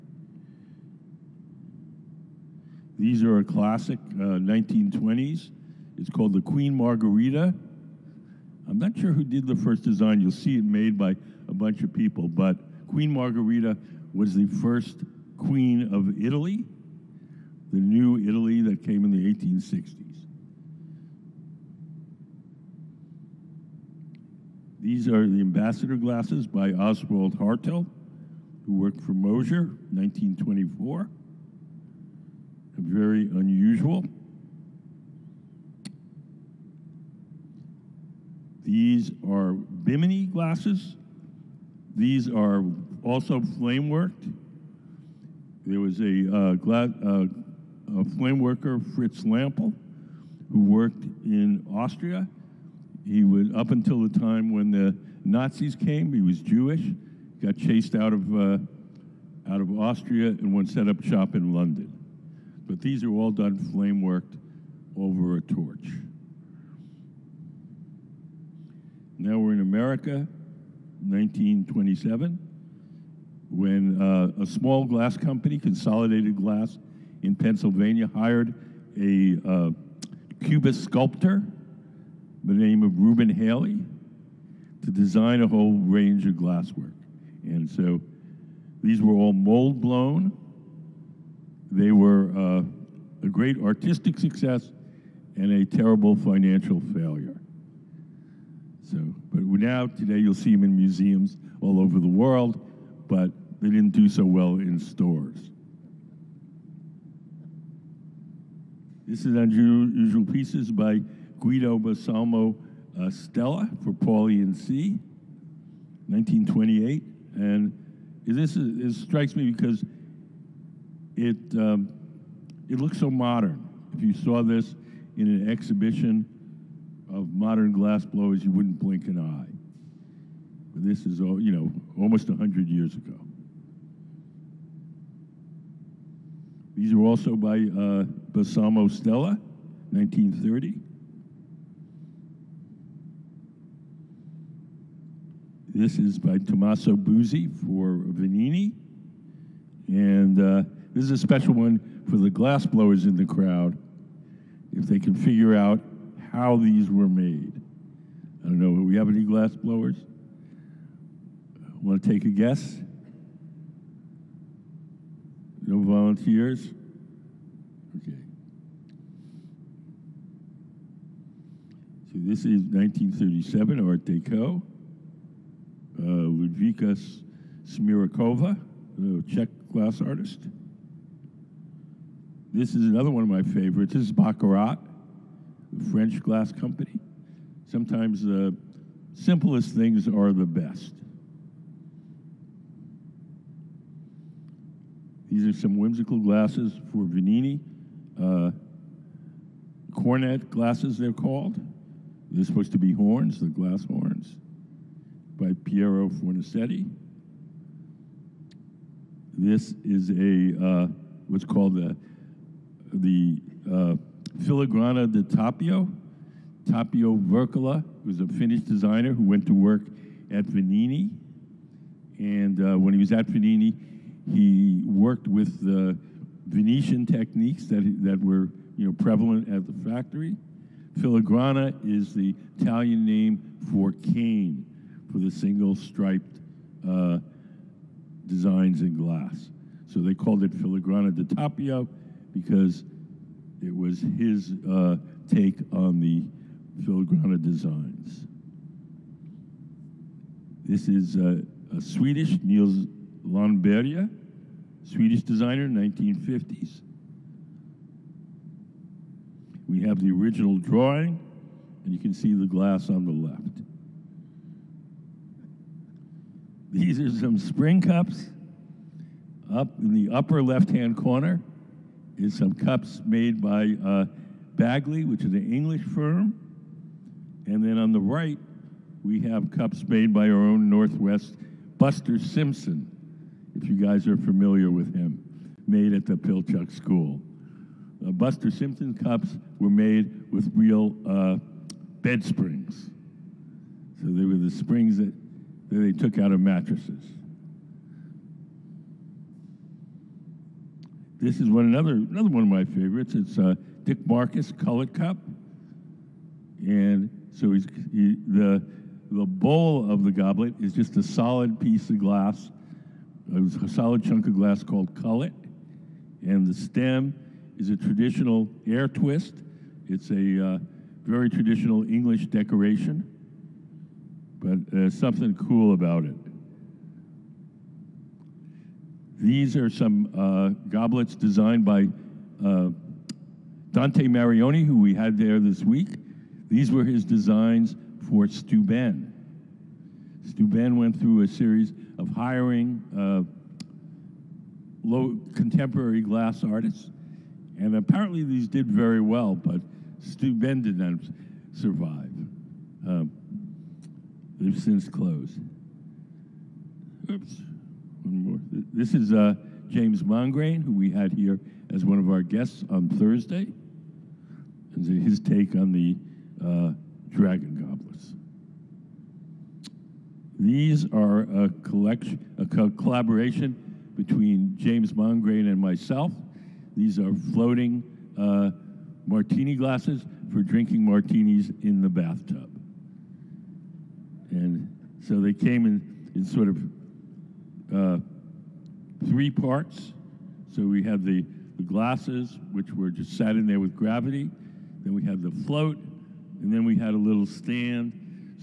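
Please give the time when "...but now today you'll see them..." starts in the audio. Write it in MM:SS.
01:39.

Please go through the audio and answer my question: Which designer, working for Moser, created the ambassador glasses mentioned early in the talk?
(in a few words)
Oswald Haerdtl.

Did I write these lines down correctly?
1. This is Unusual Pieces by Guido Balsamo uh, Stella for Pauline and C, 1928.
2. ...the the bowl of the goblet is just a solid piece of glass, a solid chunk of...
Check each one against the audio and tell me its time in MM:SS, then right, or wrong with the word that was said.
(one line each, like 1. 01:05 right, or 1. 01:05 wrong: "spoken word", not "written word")
1. 01:49 right
2. 05:08 right.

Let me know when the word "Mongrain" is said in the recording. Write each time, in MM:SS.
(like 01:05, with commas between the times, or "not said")
06:00, 06:14.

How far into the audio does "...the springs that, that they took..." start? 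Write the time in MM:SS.
04:54.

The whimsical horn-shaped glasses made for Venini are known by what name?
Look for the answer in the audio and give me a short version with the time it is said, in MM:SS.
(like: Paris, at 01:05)
cornet glasses, at 03:19.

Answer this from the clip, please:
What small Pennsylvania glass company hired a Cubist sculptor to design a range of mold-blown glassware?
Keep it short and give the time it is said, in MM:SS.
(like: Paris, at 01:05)
Consolidated Glass, at 01:15.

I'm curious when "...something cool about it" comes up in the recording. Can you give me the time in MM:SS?
05:24.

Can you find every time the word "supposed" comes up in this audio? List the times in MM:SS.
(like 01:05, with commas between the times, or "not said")
03:22.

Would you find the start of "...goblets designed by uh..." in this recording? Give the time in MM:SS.
05:30.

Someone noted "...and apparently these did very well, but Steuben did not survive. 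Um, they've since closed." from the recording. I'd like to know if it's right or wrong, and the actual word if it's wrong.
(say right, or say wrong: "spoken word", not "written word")
right.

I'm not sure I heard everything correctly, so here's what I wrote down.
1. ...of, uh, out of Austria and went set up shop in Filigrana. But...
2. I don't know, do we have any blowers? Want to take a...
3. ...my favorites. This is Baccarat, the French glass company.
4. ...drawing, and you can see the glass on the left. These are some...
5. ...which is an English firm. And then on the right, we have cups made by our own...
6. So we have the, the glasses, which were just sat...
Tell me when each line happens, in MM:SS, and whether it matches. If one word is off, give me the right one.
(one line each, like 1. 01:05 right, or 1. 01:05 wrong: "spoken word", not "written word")
1. 00:58 wrong: "London", not "Filigrana"
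2. 02:38 wrong: "glassblowers", not "blowers"
3. 03:03 right
4. 04:20 right
5. 04:35 right
6. 06:30 right.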